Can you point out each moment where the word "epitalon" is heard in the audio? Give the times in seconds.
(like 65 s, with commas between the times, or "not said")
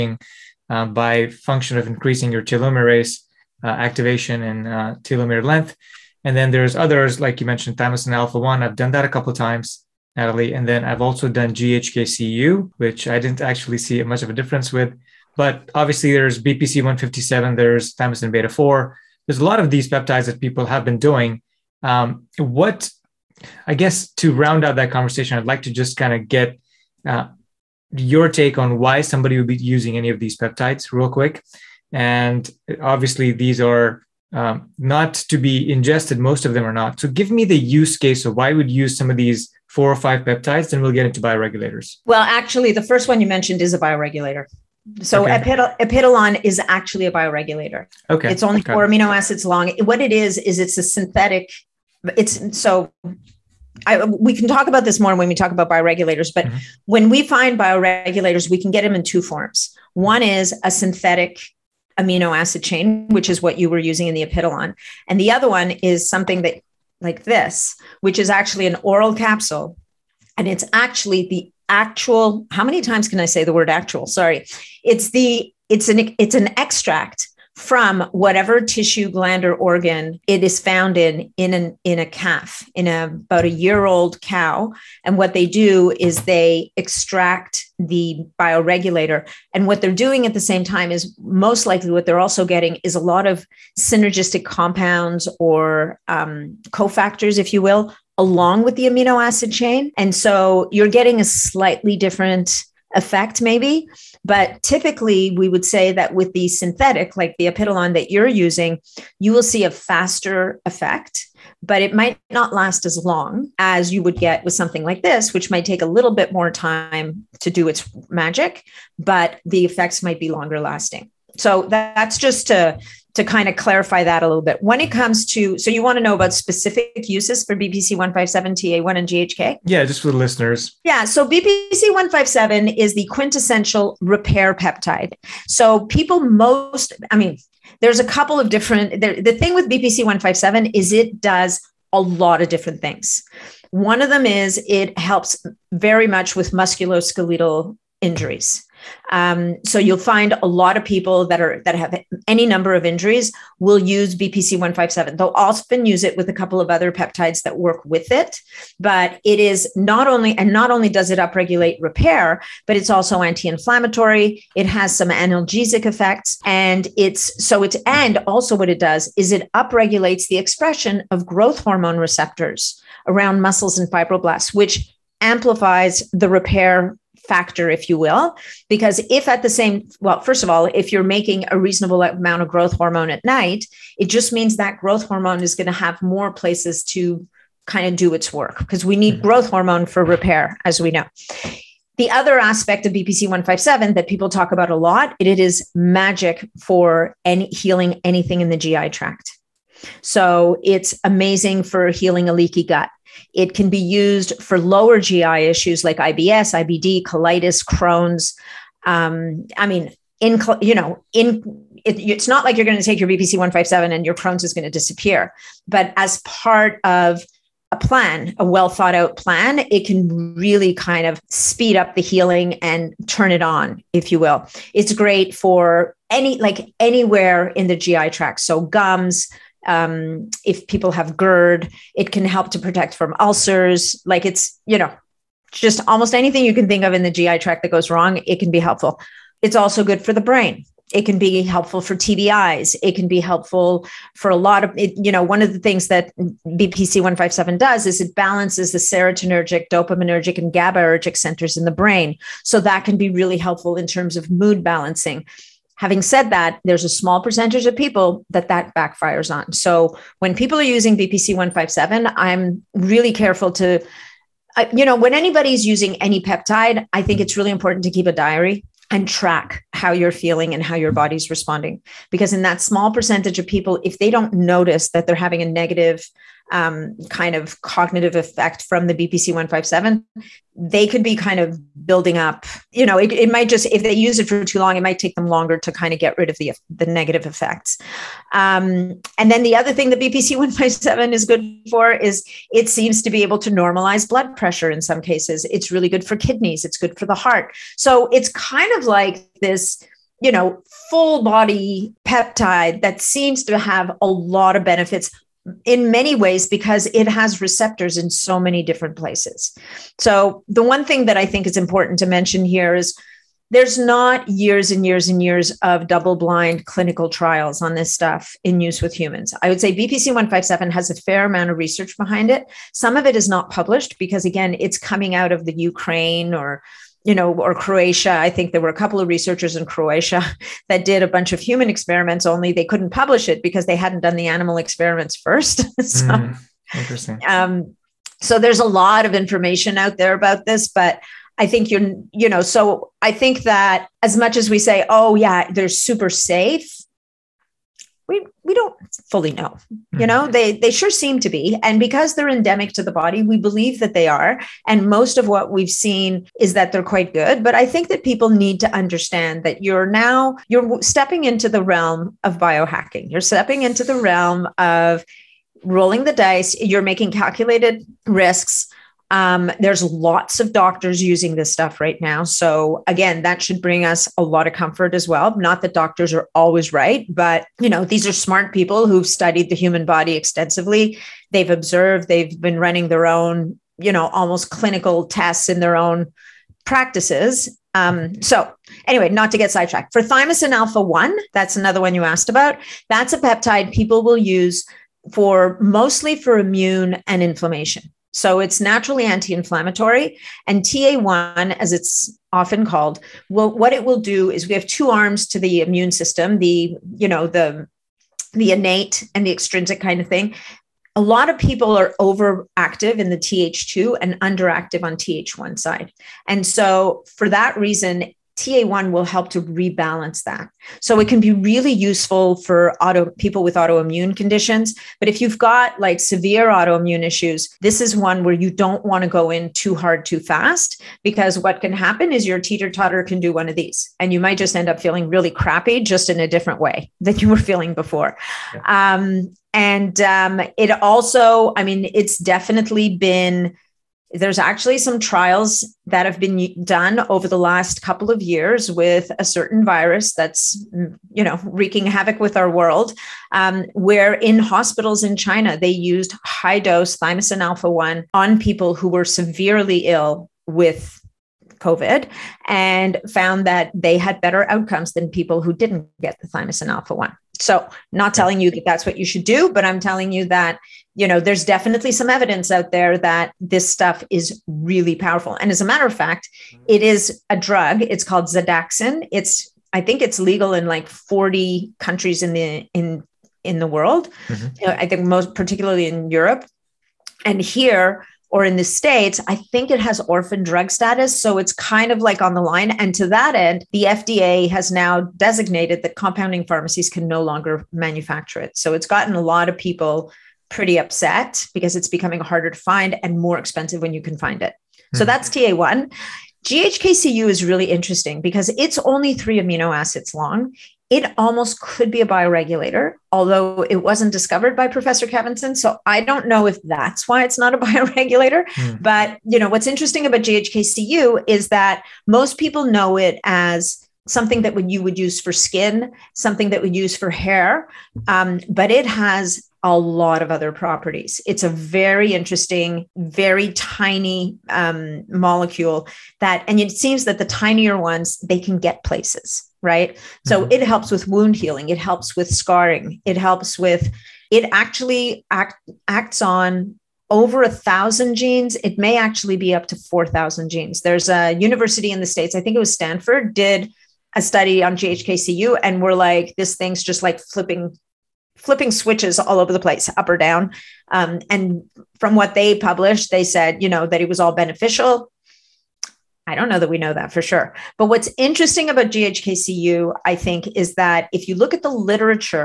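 45 s, 64 s, 107 s.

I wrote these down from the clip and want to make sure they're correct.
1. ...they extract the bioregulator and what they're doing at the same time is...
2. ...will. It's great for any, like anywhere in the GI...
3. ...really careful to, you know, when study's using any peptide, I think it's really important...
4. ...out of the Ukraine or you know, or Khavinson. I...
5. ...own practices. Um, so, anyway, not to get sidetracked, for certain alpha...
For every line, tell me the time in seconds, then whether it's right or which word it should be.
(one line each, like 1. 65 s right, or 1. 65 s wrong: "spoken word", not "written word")
1. 86 s right
2. 224 s right
3. 262 s wrong: "anybody", not "study"
4. 325 s wrong: "Croatia", not "Khavinson"
5. 385 s wrong: "thymosin", not "certain".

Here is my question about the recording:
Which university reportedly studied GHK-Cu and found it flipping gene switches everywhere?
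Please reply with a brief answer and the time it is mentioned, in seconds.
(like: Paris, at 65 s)
Stanford, at 552 s.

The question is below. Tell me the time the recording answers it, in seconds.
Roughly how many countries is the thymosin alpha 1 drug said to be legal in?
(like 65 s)
480 s.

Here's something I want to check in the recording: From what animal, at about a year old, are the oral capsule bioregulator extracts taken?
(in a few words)
calf.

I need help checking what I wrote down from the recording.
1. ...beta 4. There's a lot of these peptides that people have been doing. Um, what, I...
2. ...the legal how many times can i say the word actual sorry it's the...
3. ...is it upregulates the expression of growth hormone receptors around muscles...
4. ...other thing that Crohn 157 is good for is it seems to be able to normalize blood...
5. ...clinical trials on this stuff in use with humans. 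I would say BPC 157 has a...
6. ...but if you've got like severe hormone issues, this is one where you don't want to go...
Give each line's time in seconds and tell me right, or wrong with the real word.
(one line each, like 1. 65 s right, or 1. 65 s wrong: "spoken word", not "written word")
1. 18 s right
2. 71 s wrong: "actual", not "legal"
3. 169 s right
4. 289 s wrong: "BPC", not "Crohn"
5. 316 s right
6. 424 s wrong: "autoimmune", not "hormone".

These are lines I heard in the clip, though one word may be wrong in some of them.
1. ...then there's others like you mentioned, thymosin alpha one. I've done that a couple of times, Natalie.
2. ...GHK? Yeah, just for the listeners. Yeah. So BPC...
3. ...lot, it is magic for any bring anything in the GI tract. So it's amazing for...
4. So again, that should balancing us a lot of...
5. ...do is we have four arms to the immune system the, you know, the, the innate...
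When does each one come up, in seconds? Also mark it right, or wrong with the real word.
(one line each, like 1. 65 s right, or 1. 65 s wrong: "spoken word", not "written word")
1. 6 s right
2. 129 s right
3. 194 s wrong: "healing", not "bring"
4. 372 s wrong: "bring", not "balancing"
5. 403 s wrong: "two", not "four".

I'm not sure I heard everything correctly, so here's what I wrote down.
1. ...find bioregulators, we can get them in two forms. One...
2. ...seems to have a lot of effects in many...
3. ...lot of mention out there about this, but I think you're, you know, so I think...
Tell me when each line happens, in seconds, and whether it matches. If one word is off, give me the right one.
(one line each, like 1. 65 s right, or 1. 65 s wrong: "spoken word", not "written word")
1. 57 s right
2. 303 s wrong: "benefits", not "effects"
3. 338 s wrong: "information", not "mention".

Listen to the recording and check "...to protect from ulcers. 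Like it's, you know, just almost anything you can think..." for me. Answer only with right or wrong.
right.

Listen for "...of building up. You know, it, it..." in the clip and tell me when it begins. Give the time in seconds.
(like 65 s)
281 s.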